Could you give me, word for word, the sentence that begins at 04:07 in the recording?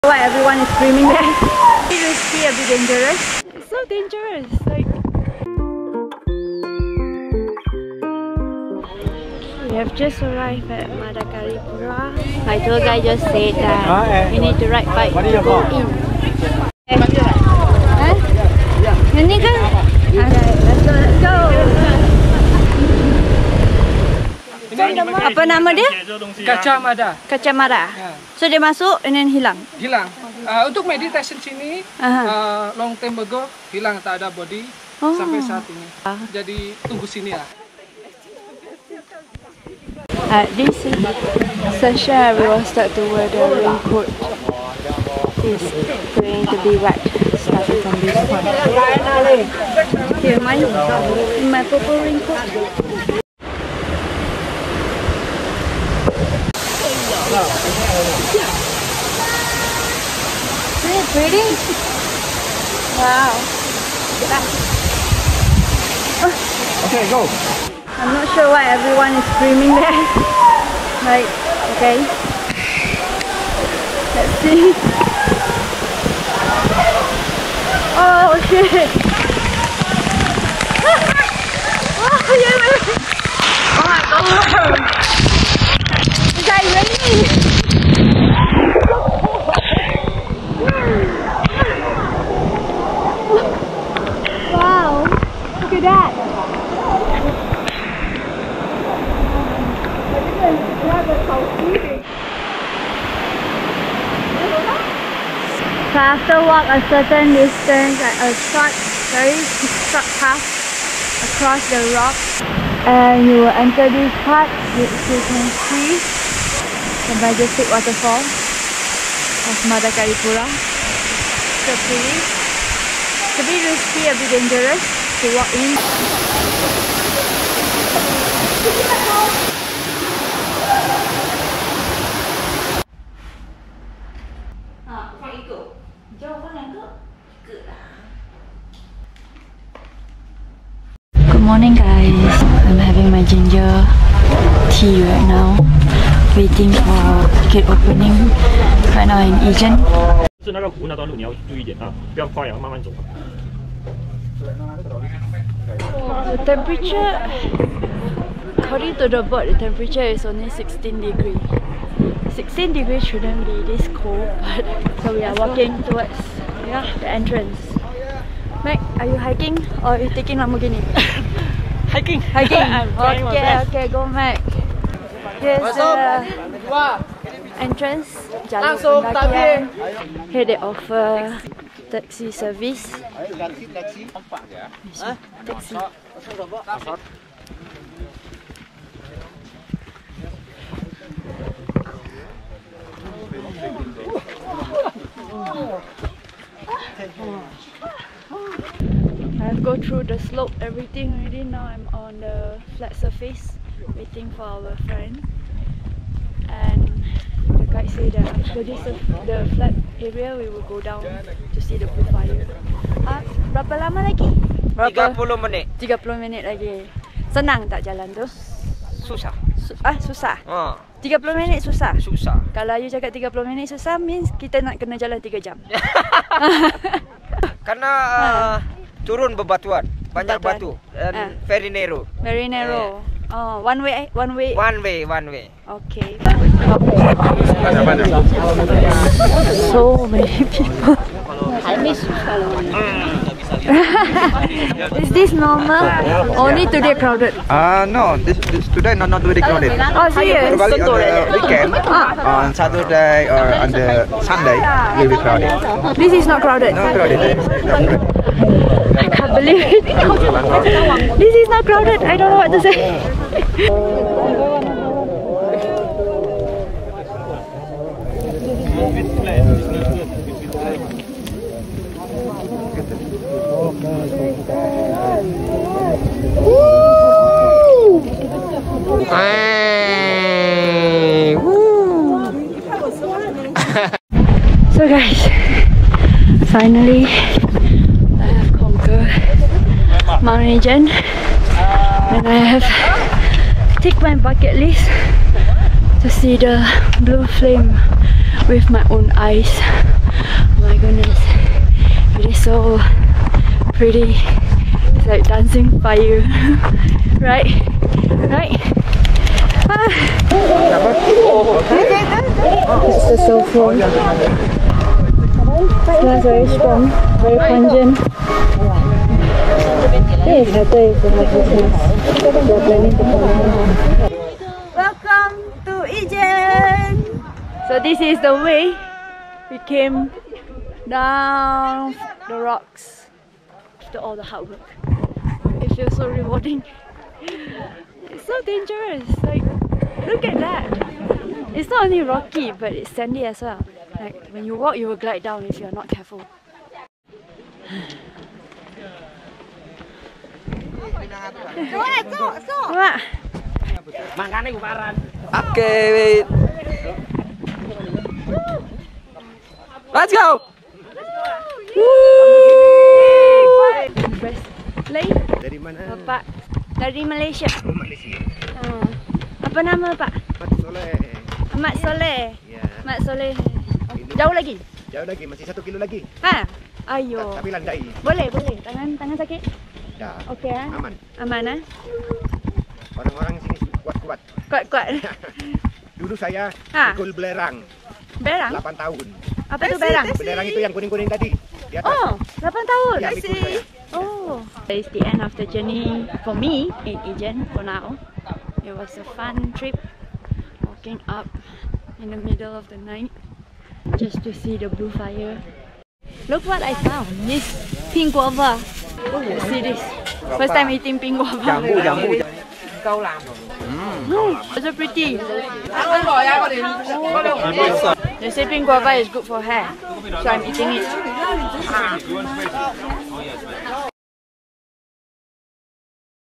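Uh, no, this, this today not, not really crowded.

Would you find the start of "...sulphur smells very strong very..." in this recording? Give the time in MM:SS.
05:13.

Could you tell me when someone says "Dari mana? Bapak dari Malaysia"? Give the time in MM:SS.
06:05.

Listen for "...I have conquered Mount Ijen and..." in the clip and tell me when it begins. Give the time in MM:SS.
04:48.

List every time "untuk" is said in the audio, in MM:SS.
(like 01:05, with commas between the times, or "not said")
00:30.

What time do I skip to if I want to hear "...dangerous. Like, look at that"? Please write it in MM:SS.
05:38.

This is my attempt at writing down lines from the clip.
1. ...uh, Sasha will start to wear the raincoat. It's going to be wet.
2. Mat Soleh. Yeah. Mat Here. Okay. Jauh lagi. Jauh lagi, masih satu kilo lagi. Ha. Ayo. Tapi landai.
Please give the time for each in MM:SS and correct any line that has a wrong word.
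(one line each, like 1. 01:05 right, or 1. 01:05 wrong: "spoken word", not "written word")
1. 00:40 right
2. 06:11 wrong: "Soleh", not "Here".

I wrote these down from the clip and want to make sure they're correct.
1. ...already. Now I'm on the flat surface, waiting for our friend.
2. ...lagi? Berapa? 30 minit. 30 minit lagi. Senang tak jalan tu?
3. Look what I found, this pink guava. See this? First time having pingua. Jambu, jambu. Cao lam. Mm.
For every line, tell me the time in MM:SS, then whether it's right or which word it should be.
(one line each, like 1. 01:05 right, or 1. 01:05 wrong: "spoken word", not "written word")
1. 03:21 right
2. 03:34 right
3. 06:46 wrong: "eating", not "having".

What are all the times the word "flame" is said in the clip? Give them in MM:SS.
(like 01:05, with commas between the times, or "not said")
04:57.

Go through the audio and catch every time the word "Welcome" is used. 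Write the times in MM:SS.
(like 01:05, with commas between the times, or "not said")
05:24.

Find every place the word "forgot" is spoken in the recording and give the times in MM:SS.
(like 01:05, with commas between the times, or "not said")
not said.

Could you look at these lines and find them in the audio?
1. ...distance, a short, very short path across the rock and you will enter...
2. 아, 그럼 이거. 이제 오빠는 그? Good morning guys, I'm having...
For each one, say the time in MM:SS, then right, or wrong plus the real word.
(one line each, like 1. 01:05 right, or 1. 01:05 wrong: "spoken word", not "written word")
1. 01:47 right
2. 02:14 right.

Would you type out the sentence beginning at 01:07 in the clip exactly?
I'm not sure why everyone is screaming there.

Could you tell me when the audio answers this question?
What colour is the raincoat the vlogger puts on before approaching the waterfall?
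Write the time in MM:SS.
00:51.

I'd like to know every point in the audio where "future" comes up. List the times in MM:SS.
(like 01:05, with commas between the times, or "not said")
not said.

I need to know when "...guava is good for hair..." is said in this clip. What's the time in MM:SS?
06:58.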